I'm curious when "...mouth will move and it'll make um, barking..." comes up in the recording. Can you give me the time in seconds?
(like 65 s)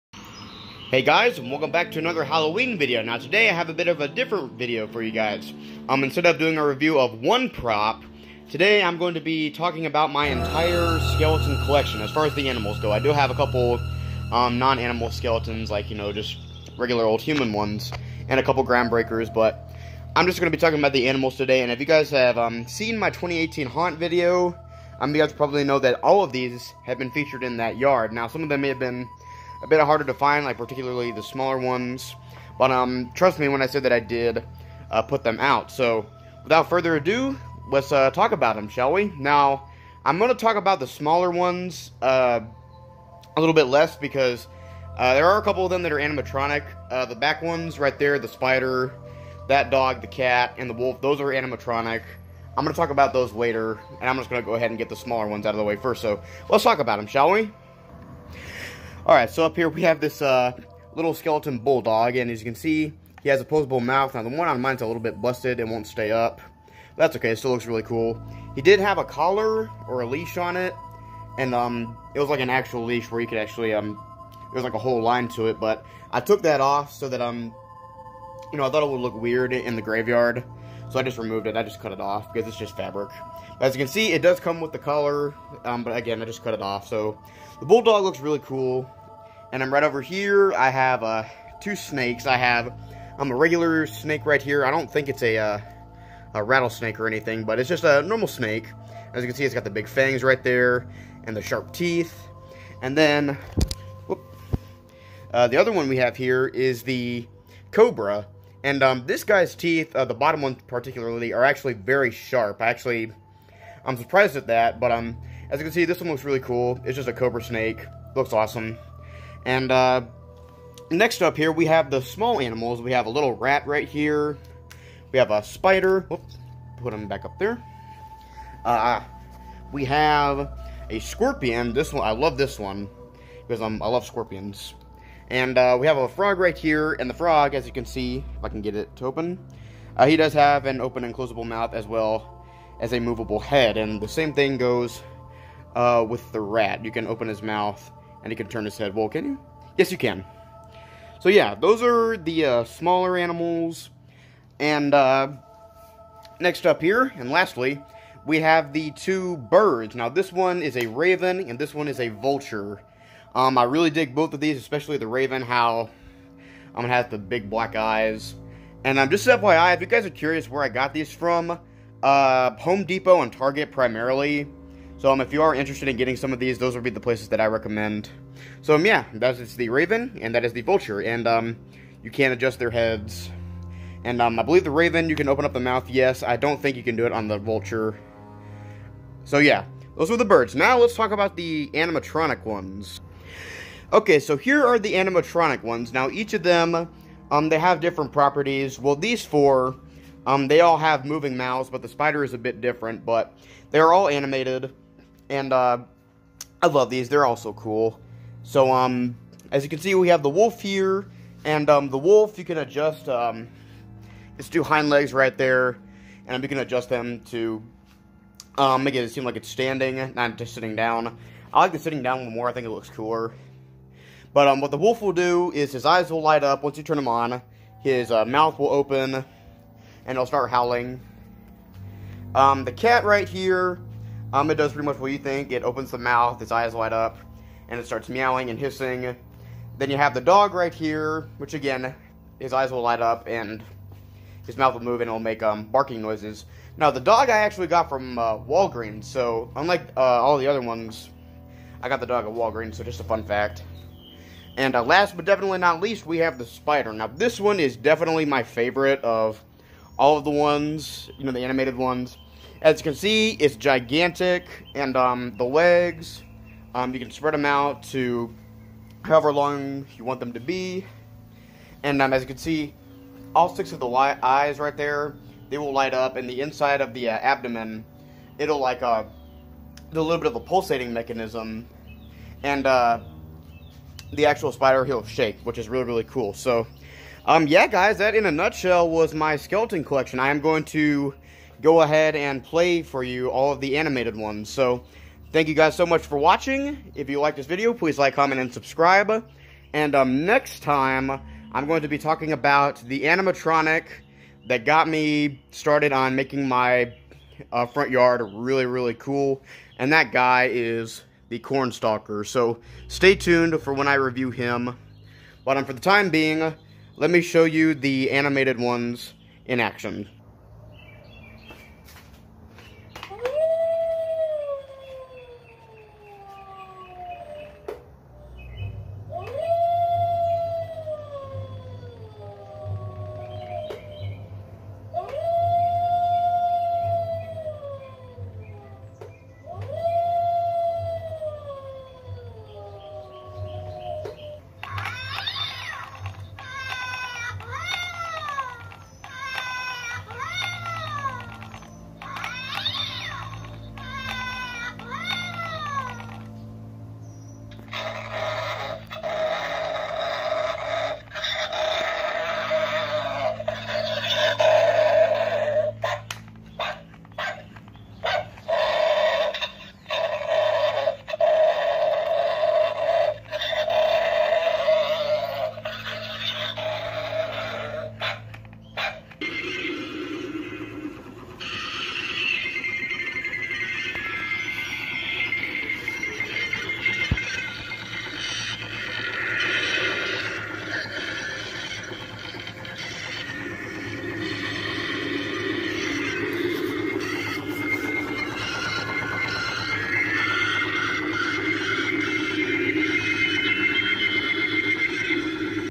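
244 s.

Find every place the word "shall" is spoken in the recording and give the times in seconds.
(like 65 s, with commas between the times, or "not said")
38 s, 57 s.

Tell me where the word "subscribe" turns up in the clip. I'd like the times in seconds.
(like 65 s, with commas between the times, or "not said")
298 s.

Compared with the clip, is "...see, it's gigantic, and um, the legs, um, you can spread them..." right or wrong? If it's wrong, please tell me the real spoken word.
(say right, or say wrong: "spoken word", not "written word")
right.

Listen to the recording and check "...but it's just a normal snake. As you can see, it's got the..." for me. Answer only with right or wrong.
right.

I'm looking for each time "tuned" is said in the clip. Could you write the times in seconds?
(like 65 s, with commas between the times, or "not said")
313 s.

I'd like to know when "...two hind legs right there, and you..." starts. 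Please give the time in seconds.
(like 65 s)
214 s.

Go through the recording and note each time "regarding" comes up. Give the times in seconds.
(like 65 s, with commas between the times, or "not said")
not said.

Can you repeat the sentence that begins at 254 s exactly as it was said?
And uh, last but definitely not least, we have the spider.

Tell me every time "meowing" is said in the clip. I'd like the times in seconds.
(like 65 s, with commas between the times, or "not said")
238 s.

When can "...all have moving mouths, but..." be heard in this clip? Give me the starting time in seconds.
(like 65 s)
200 s.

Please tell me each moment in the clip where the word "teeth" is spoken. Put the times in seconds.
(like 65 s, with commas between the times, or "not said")
101 s, 109 s.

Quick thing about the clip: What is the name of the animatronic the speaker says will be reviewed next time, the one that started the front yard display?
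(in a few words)
Cornstalker.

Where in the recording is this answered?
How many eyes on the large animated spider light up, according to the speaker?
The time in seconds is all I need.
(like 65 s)
273 s.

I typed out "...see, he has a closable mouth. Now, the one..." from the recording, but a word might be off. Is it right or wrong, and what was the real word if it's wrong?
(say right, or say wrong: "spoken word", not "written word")
wrong: "posable", not "closable".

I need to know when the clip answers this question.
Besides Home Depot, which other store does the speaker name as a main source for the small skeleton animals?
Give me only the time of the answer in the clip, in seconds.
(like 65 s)
173 s.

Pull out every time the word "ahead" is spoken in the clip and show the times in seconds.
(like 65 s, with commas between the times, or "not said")
54 s, 291 s.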